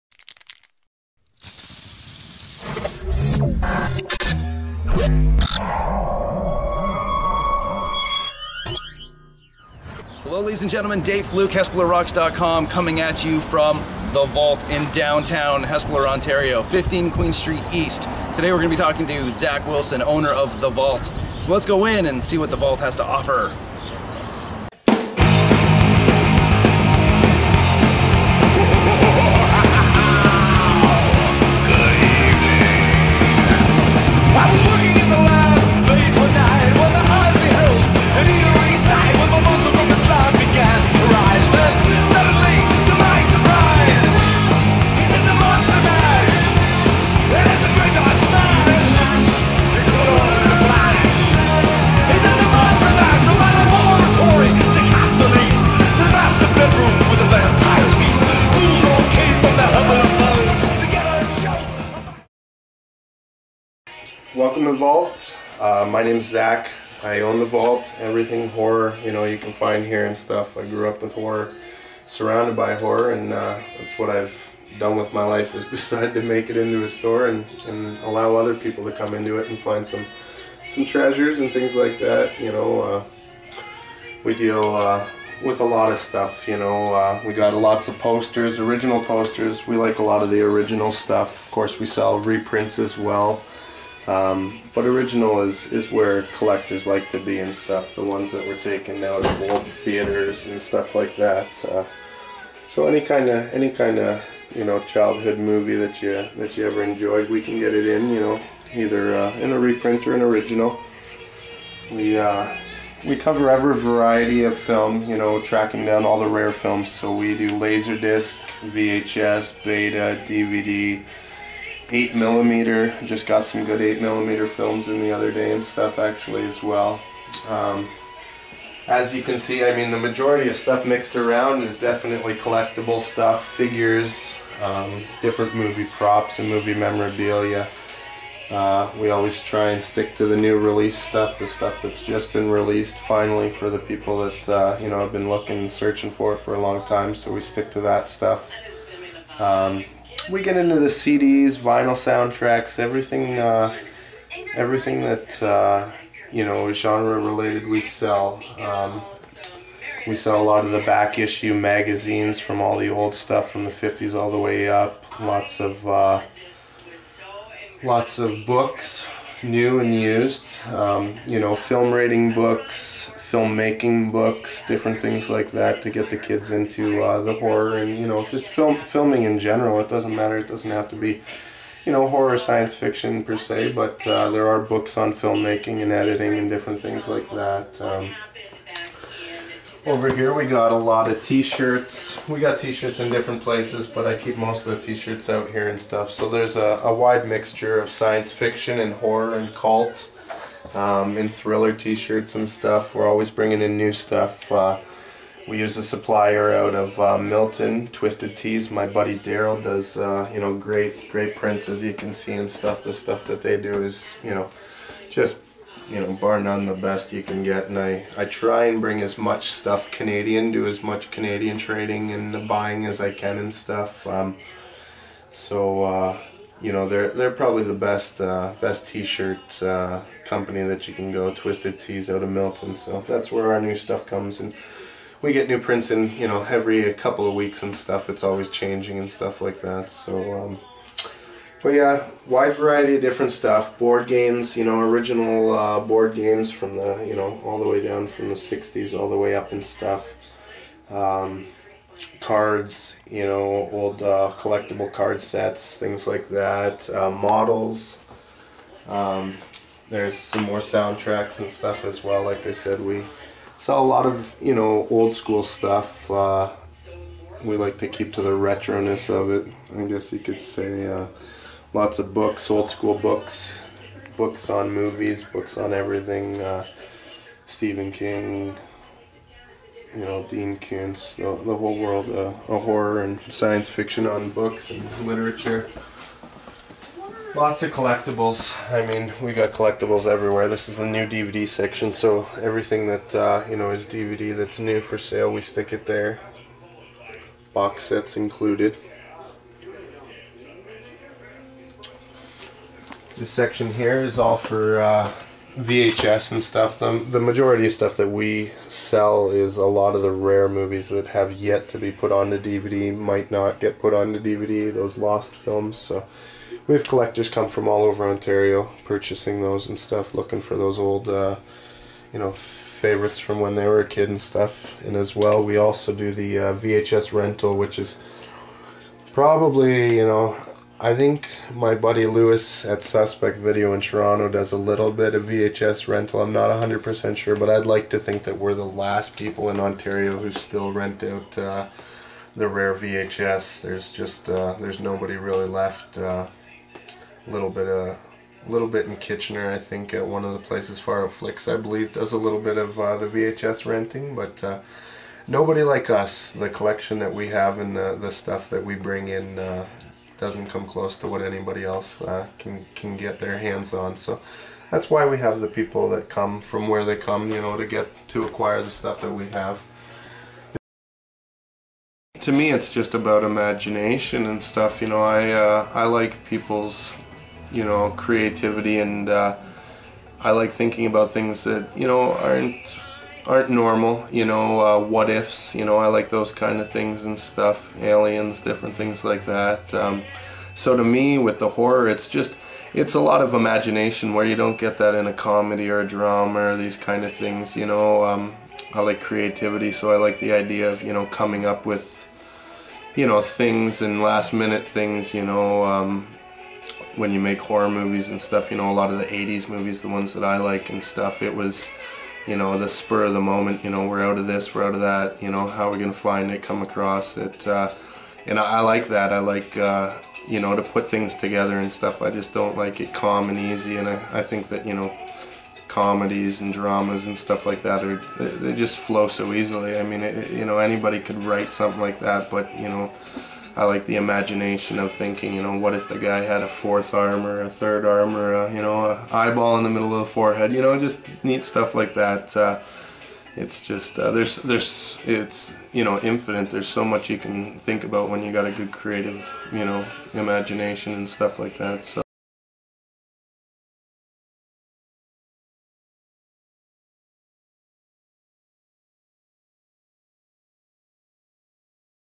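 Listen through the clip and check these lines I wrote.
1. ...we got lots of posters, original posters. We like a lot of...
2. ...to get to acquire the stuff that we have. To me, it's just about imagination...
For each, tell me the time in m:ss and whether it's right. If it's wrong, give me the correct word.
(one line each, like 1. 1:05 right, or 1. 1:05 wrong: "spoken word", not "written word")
1. 1:27 right
2. 6:07 right.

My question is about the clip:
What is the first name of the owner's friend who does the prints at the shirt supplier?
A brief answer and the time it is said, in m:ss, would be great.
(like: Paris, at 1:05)
Daryl, at 3:29.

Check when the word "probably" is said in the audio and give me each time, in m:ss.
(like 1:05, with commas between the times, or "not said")
3:47, 5:29.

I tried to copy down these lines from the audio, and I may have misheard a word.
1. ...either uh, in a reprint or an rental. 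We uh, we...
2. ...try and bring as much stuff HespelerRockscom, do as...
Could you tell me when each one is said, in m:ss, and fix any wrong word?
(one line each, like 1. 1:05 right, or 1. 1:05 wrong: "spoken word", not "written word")
1. 1:48 wrong: "original", not "rental"
2. 3:38 wrong: "Canadian", not "HespelerRockscom".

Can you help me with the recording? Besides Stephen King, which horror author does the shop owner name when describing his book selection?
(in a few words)
Dean Koontz.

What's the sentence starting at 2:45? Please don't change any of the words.
Lots of uh, lots of books new and used.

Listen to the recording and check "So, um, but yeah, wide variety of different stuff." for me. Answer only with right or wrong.
right.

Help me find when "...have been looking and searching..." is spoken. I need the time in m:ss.
2:24.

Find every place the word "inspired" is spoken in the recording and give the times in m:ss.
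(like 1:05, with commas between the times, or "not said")
not said.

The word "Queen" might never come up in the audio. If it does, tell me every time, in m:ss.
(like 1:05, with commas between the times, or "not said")
0:17.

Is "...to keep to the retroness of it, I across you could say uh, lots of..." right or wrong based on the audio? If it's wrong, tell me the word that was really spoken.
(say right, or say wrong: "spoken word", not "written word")
wrong: "guess", not "across".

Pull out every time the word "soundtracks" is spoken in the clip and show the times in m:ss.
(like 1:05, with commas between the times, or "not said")
2:31, 4:20.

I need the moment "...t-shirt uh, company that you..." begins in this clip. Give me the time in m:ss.
3:48.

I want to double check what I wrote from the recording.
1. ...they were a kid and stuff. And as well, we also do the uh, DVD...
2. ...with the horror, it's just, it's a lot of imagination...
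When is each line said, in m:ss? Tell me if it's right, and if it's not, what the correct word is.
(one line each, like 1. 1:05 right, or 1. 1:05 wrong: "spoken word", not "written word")
1. 5:23 wrong: "VHS", not "DVD"
2. 6:31 right.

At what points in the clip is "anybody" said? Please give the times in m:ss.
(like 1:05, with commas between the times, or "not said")
6:01, 7:10.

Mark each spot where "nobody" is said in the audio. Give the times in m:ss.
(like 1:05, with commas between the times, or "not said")
5:44, 5:55.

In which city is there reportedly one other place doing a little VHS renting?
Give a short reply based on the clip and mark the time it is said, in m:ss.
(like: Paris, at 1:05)
Kitchener, at 5:48.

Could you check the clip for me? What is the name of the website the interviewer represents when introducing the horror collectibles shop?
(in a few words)
HespelerRocks.com.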